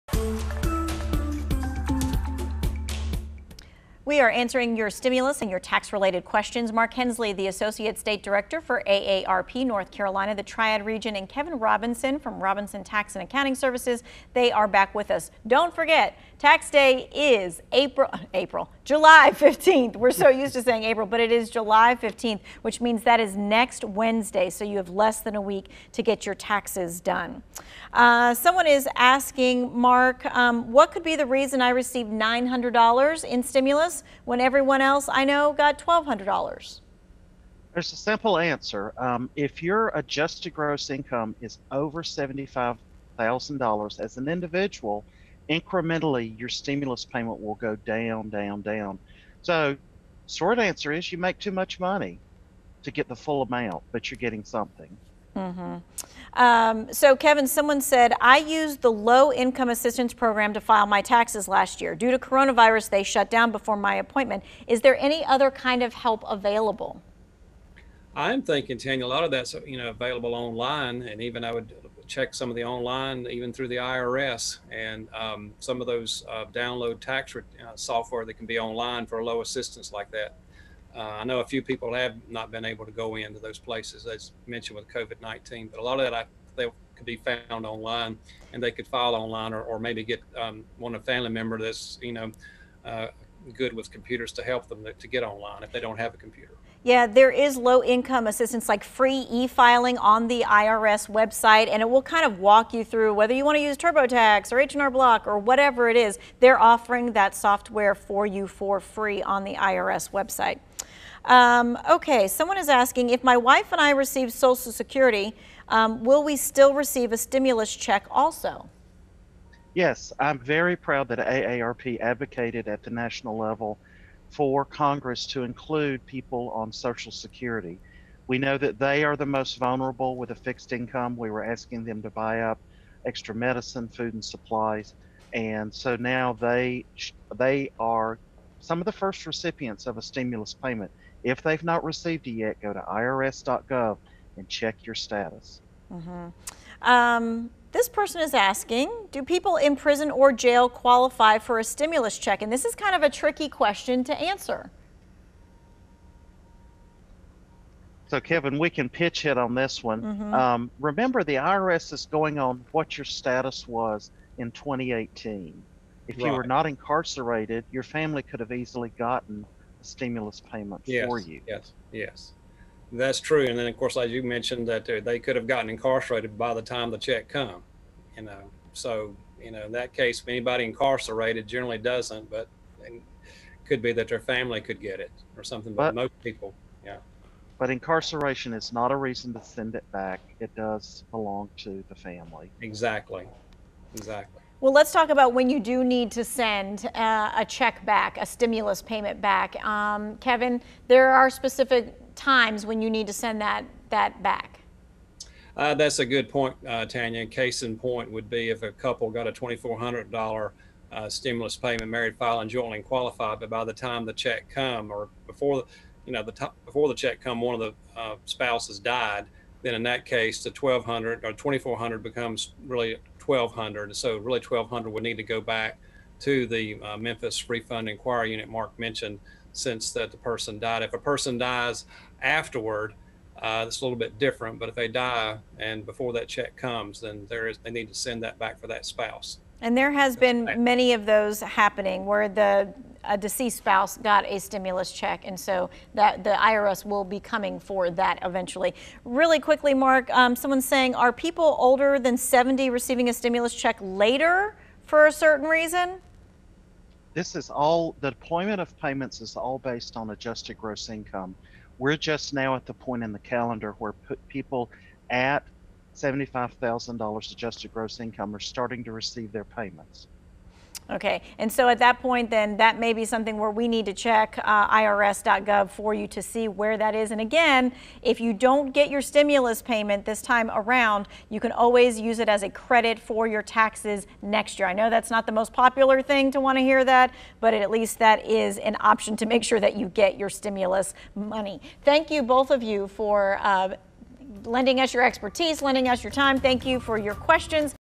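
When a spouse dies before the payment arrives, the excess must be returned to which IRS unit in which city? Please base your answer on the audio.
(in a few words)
Memphis Refund Inquiry Unit.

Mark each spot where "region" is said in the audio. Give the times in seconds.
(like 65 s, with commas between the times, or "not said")
10 s.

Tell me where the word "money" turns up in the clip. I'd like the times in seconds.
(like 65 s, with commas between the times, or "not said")
51 s, 291 s.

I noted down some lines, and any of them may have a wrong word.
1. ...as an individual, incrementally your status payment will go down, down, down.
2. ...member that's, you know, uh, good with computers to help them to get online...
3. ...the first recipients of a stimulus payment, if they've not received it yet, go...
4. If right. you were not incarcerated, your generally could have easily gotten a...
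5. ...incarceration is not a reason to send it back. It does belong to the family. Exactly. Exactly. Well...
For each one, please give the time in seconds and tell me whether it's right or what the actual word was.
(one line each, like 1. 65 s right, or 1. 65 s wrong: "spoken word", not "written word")
1. 43 s wrong: "stimulus", not "status"
2. 91 s right
3. 138 s right
4. 166 s wrong: "family", not "generally"
5. 187 s right.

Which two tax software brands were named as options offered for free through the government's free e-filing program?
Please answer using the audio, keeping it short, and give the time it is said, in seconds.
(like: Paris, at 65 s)
TurboTax or H&R Block, at 103 s.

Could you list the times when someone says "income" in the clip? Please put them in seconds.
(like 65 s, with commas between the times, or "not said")
40 s, 59 s, 97 s, 130 s, 260 s, 267 s.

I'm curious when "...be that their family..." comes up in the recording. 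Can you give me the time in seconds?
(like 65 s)
183 s.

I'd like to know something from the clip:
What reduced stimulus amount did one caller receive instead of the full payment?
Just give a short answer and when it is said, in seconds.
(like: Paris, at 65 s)
$900, at 32 s.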